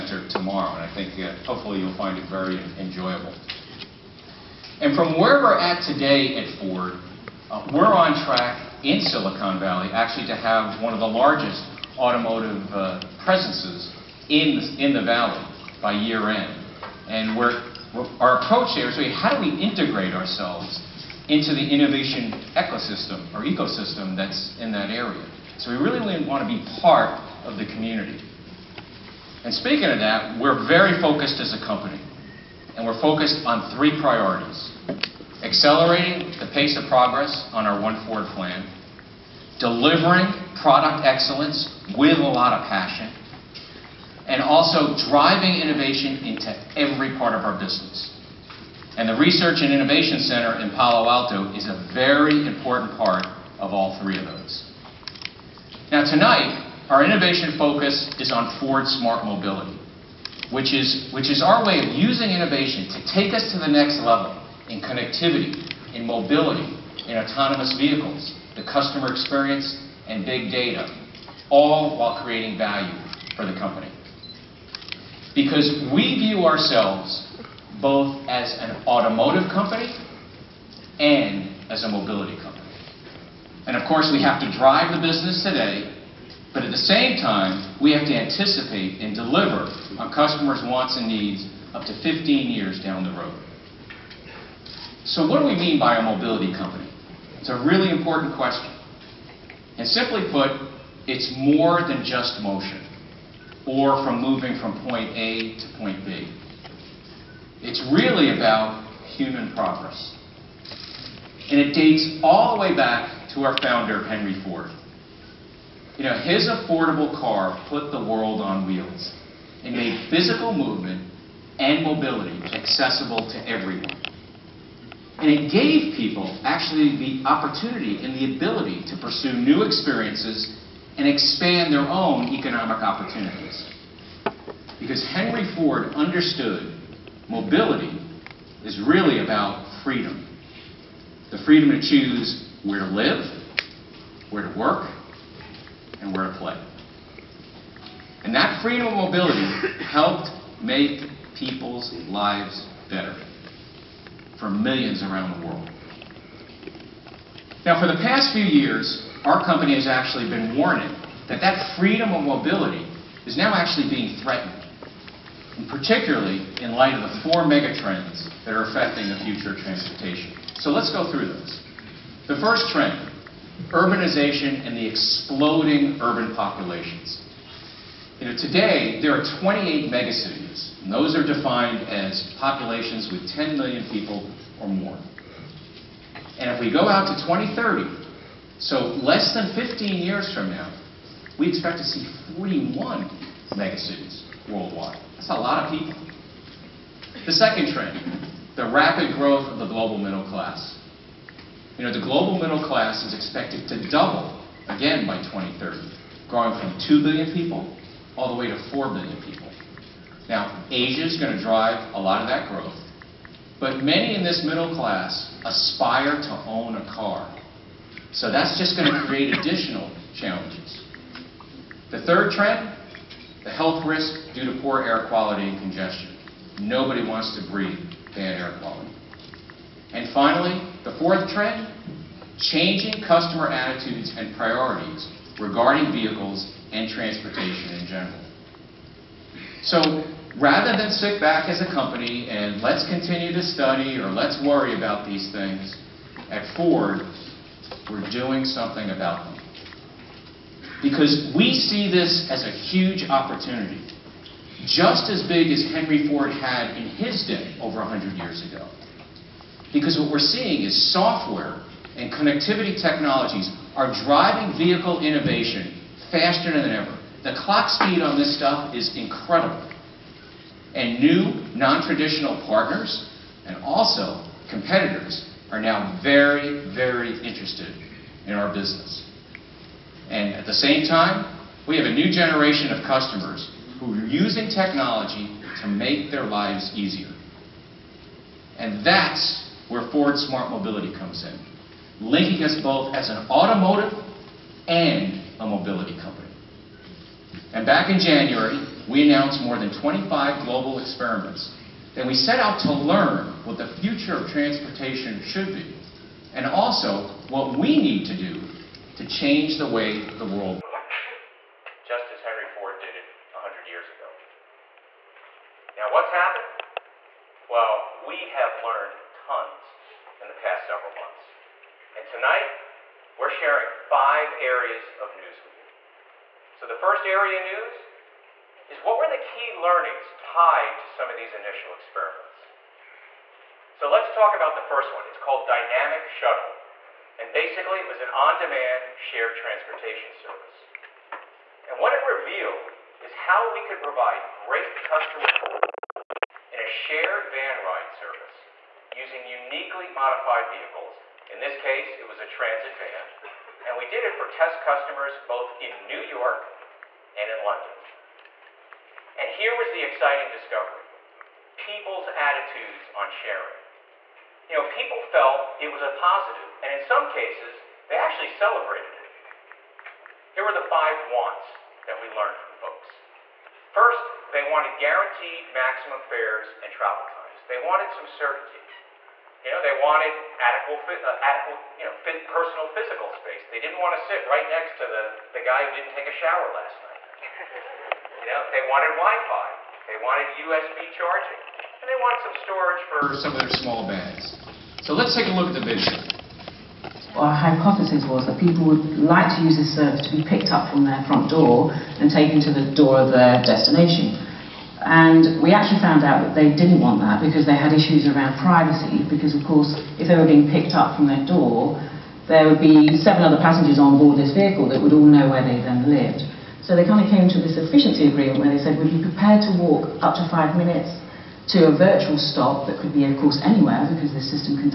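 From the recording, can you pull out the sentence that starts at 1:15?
Because we view ourselves both as an automotive company and as a mobility company.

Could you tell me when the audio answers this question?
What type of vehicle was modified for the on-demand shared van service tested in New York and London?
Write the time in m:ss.
5:52.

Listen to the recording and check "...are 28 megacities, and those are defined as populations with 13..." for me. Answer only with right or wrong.
wrong.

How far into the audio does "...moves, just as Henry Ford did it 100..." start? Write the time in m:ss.
5:10.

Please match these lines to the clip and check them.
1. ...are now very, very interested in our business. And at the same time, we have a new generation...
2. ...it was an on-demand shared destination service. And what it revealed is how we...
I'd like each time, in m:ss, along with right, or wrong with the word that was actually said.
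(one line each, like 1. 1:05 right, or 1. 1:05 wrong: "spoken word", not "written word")
1. 4:35 right
2. 5:37 wrong: "transportation", not "destination".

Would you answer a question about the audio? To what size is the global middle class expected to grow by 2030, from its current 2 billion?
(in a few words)
4 billion.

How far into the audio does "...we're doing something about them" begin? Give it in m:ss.
4:07.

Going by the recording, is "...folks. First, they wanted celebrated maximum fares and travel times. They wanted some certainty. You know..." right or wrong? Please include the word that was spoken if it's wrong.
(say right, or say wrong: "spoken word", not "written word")
wrong: "guaranteed", not "celebrated".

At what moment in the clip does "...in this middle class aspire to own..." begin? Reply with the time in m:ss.
3:34.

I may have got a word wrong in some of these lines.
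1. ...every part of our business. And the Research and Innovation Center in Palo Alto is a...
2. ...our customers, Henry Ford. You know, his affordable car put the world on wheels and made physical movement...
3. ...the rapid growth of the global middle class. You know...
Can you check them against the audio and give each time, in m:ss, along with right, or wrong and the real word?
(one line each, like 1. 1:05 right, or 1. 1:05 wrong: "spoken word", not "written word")
1. 0:46 right
2. 1:53 wrong: "founder", not "customers"
3. 3:18 right.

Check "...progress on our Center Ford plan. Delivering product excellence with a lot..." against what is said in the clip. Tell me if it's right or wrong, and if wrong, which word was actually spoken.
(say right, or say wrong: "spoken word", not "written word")
wrong: "One", not "Center".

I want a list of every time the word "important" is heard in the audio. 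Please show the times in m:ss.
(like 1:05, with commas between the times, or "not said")
0:52, 1:37.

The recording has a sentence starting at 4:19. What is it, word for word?
Because what we're seeing is software and connectivity technologies are driving vehicle innovation faster than ever.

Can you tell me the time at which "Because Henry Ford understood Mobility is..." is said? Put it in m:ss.
2:14.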